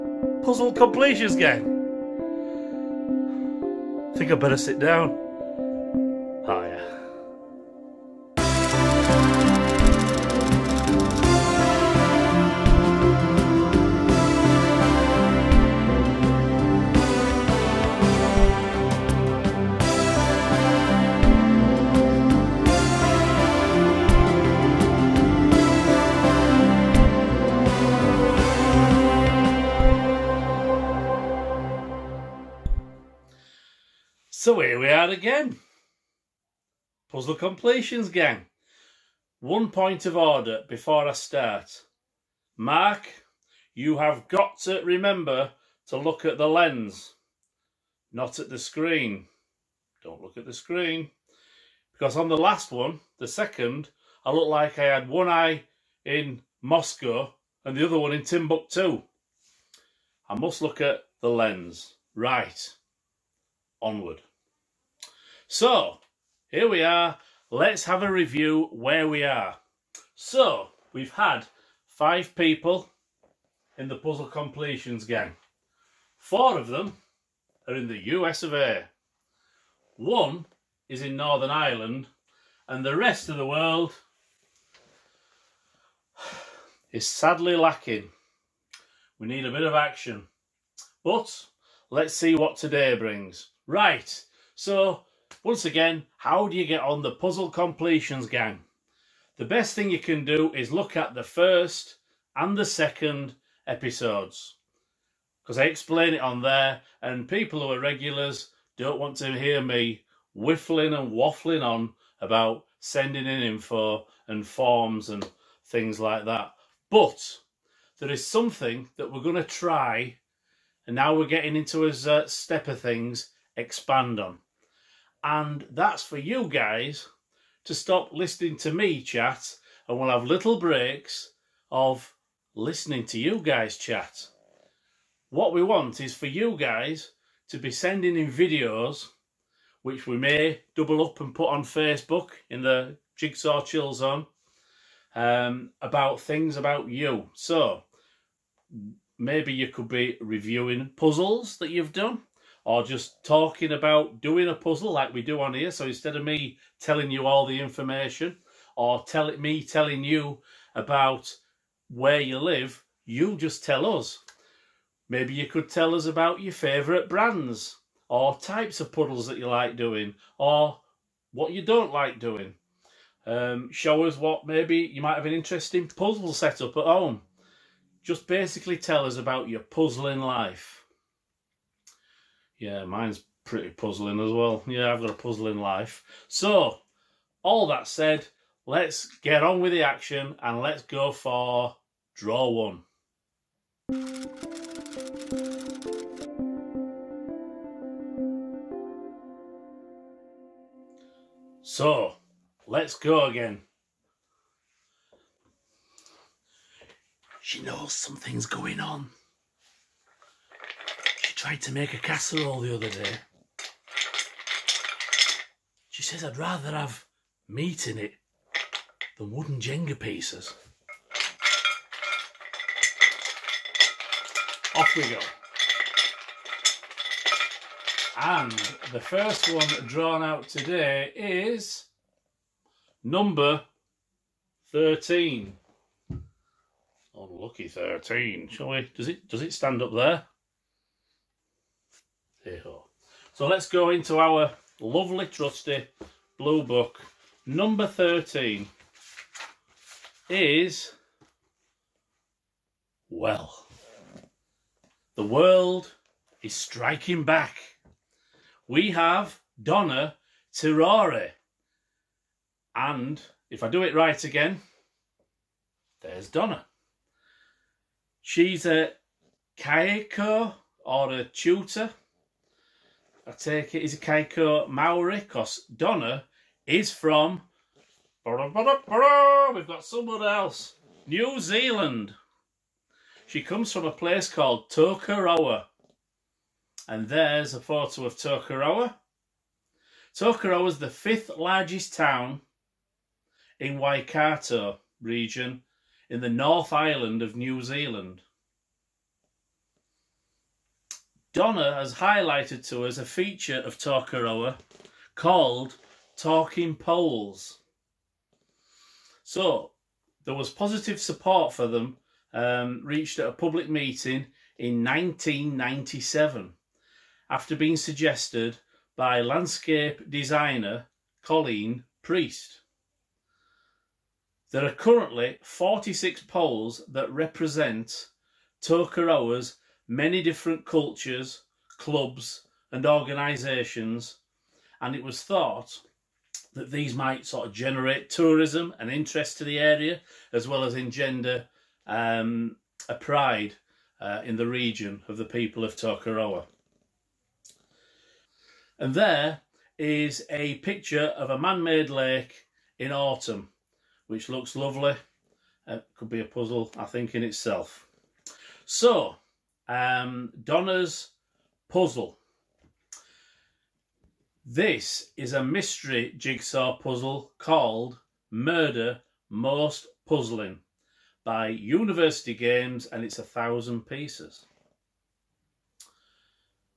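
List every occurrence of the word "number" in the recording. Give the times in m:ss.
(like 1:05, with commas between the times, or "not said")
3:53, 4:07.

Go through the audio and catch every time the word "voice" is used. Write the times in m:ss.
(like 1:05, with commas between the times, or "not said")
not said.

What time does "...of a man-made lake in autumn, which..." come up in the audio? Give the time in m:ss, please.
5:51.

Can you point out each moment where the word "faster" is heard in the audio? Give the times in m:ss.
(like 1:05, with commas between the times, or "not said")
not said.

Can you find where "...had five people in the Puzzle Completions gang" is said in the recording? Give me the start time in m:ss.
1:11.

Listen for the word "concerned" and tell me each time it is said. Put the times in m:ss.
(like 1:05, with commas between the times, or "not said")
not said.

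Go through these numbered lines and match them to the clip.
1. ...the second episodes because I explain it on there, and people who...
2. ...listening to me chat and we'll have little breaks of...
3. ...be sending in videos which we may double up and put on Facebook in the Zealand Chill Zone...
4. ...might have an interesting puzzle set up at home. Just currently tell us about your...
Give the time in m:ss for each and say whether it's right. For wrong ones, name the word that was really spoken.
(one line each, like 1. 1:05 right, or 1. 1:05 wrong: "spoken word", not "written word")
1. 1:42 right
2. 2:08 right
3. 2:17 wrong: "Jigsaw", not "Zealand"
4. 2:55 wrong: "basically", not "currently".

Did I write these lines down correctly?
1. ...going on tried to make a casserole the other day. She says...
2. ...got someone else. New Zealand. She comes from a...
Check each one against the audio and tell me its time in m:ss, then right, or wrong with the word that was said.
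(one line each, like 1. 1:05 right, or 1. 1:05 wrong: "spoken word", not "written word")
1. 3:28 right
2. 4:39 right.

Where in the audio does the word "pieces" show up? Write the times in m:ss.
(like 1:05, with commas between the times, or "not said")
3:39, 6:13.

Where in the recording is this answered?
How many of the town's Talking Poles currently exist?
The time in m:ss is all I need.
5:25.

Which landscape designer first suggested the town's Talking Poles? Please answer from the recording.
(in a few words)
Colleen Priest.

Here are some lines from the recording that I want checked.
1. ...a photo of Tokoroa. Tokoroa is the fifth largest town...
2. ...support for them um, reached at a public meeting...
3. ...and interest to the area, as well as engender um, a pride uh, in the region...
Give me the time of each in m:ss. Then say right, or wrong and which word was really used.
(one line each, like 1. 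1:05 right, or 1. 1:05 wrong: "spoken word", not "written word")
1. 4:47 right
2. 5:11 right
3. 5:38 right.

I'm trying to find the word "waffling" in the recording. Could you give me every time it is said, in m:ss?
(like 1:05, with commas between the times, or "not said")
1:51.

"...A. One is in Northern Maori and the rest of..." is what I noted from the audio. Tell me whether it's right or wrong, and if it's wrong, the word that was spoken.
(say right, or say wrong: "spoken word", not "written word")
wrong: "Ireland", not "Maori".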